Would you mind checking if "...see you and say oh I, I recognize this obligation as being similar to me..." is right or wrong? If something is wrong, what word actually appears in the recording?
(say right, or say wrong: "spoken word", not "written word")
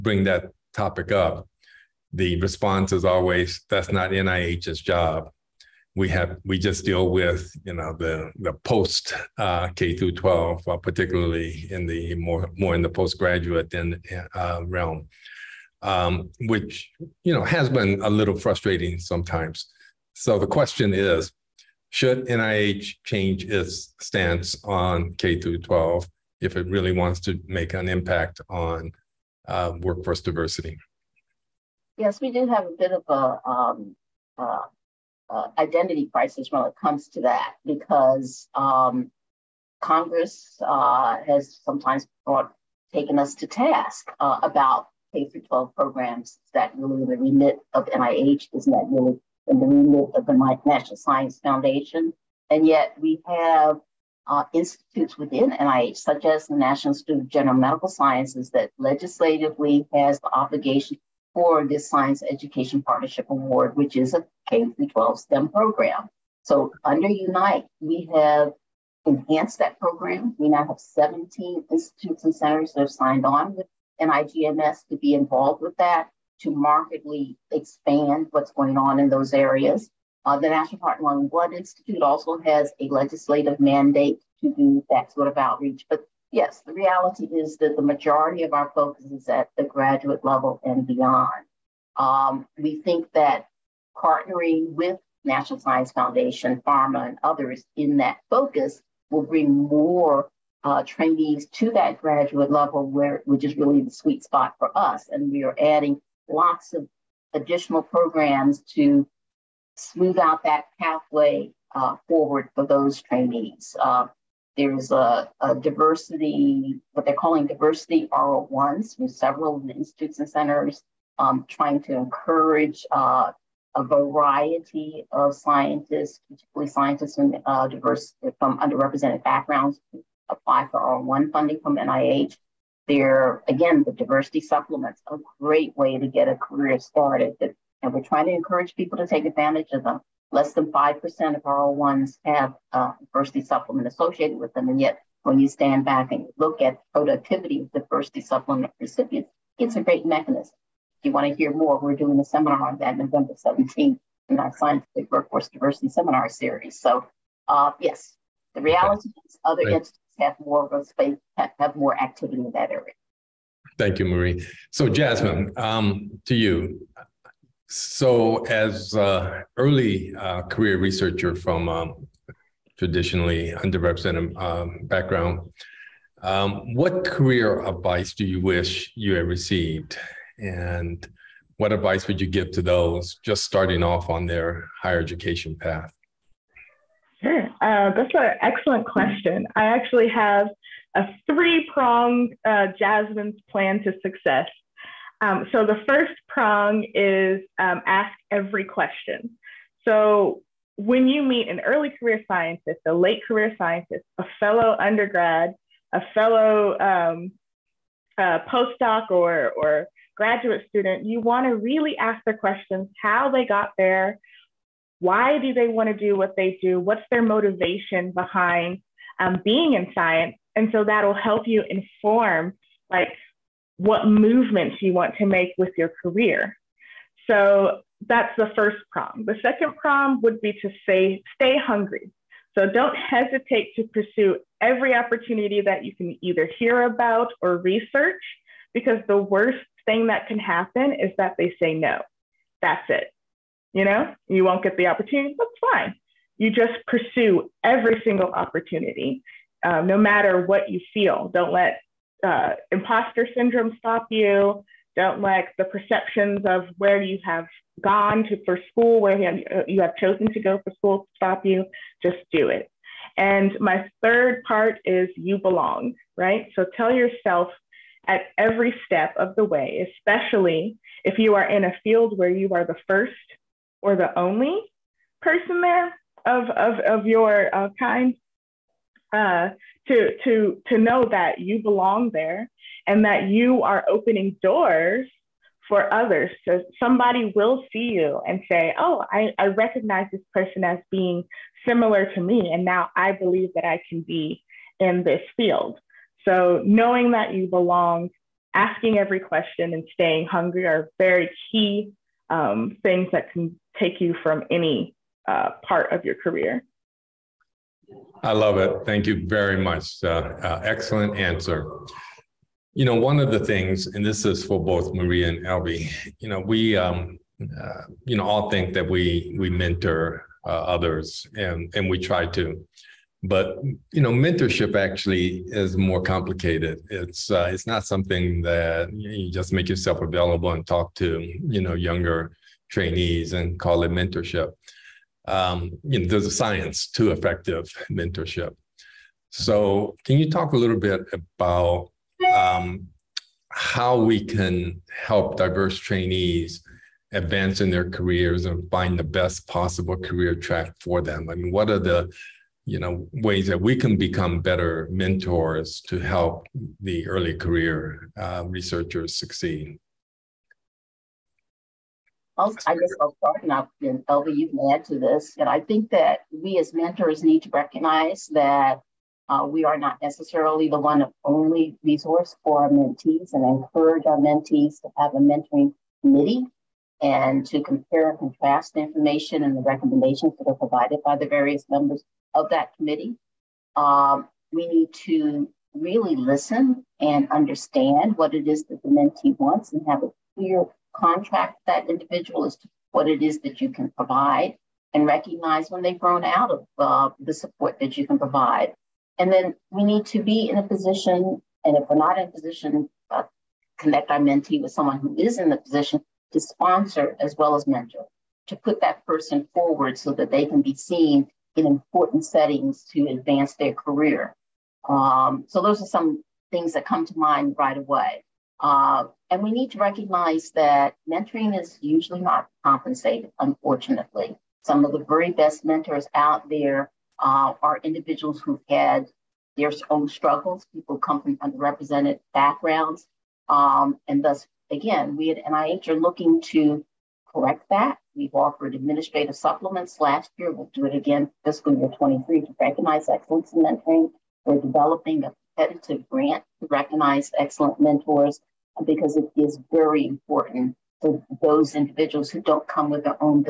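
wrong: "person", not "obligation".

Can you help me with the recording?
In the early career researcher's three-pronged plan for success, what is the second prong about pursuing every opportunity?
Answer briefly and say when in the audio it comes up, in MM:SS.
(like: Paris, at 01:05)
stay hungry, at 03:51.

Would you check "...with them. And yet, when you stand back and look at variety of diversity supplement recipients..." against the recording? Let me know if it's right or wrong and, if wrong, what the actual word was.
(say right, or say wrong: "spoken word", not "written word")
wrong: "productivity", not "variety".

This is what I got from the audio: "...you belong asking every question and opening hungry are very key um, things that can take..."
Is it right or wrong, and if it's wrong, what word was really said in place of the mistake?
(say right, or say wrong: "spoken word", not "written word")
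wrong: "staying", not "opening".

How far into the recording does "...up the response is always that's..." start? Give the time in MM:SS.
00:01.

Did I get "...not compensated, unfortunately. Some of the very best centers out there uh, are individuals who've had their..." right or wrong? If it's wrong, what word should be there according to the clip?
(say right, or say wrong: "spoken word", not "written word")
wrong: "mentors", not "centers".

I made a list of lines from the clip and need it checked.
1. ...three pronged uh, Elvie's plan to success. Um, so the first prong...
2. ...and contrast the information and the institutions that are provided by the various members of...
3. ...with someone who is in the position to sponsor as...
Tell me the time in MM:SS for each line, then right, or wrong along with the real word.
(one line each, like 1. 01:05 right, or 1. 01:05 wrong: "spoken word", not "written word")
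1. 03:11 wrong: "Jasmine", not "Elvie"
2. 06:18 wrong: "recommendations", not "institutions"
3. 06:44 right.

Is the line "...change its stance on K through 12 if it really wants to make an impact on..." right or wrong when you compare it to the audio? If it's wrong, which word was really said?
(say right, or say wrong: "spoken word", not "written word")
right.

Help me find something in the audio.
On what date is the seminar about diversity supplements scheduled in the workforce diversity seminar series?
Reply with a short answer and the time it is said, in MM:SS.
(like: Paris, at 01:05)
November 17th, at 02:32.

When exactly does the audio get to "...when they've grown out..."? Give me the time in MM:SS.
06:35.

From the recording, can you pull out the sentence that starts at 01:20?
Uh, the National Heart and Lung Blood Institute also has a legislative mandate to do that sort of outreach.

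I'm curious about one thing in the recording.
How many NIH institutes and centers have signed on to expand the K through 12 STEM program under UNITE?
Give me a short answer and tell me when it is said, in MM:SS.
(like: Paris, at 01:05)
17, at 01:10.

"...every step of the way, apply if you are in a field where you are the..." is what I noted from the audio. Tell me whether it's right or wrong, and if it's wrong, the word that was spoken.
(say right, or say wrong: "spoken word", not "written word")
wrong: "especially", not "apply".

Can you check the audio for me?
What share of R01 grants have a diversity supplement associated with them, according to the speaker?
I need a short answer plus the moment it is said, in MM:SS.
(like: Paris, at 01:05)
Less than 5%, at 02:20.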